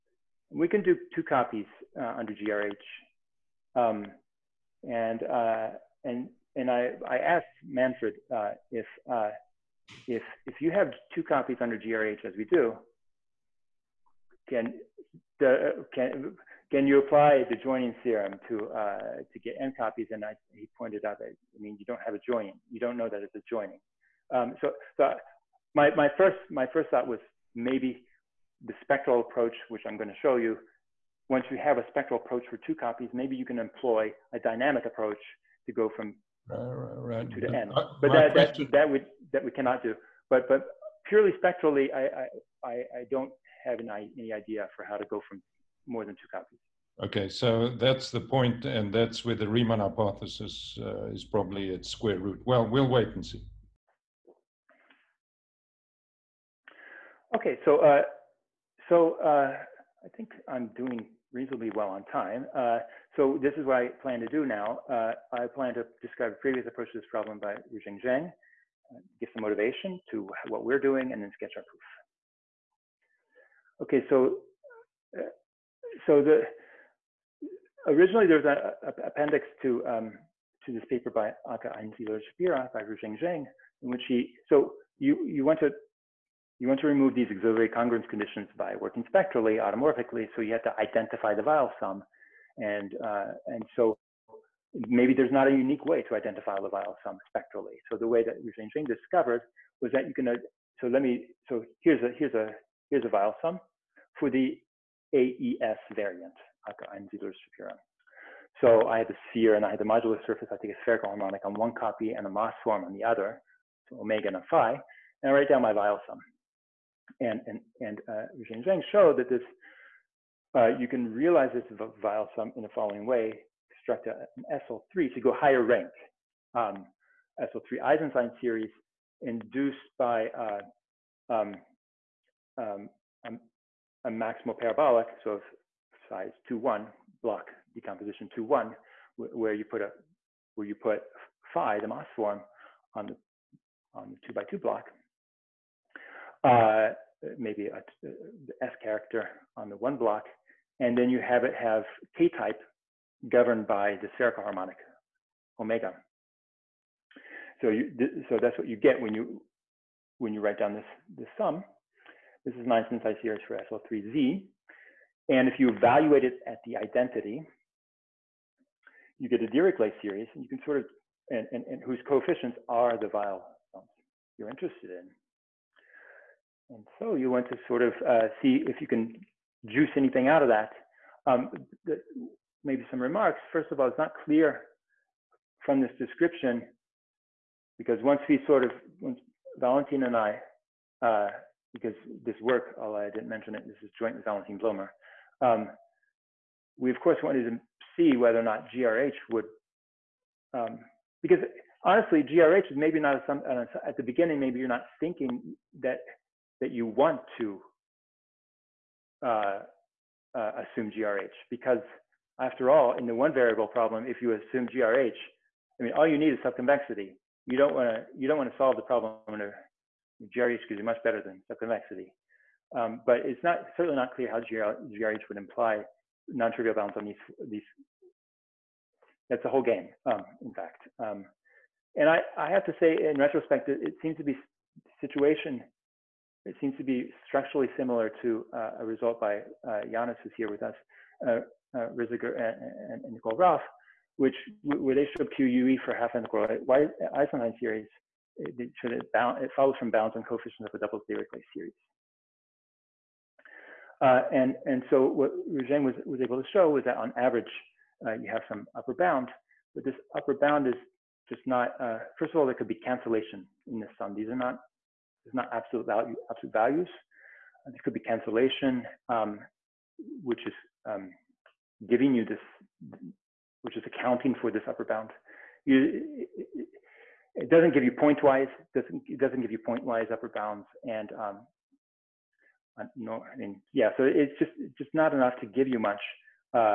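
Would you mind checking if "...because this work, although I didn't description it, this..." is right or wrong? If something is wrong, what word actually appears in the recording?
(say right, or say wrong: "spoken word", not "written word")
wrong: "mention", not "description".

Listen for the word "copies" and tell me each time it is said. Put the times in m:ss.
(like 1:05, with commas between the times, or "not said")
0:01, 0:11, 0:19, 0:32, 0:46.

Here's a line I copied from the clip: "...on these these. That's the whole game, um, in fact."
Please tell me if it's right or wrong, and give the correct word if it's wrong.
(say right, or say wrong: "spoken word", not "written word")
right.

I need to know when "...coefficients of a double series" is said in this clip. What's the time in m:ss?
4:10.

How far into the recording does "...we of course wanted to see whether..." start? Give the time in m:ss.
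3:16.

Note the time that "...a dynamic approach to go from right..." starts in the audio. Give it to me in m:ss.
0:34.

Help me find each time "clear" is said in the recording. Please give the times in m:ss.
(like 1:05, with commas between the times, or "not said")
3:04, 3:44.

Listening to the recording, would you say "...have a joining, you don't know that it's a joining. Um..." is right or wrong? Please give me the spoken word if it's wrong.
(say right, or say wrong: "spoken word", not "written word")
right.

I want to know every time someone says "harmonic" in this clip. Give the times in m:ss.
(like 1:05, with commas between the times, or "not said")
1:51, 2:34.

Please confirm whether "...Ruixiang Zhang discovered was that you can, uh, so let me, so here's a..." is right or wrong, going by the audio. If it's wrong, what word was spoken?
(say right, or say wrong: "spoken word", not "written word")
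right.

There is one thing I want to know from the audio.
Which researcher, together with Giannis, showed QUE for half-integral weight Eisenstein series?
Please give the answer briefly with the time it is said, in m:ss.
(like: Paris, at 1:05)
Nicole Raulf, at 4:03.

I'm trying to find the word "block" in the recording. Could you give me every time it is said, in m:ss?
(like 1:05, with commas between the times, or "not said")
2:17, 2:24, 2:29.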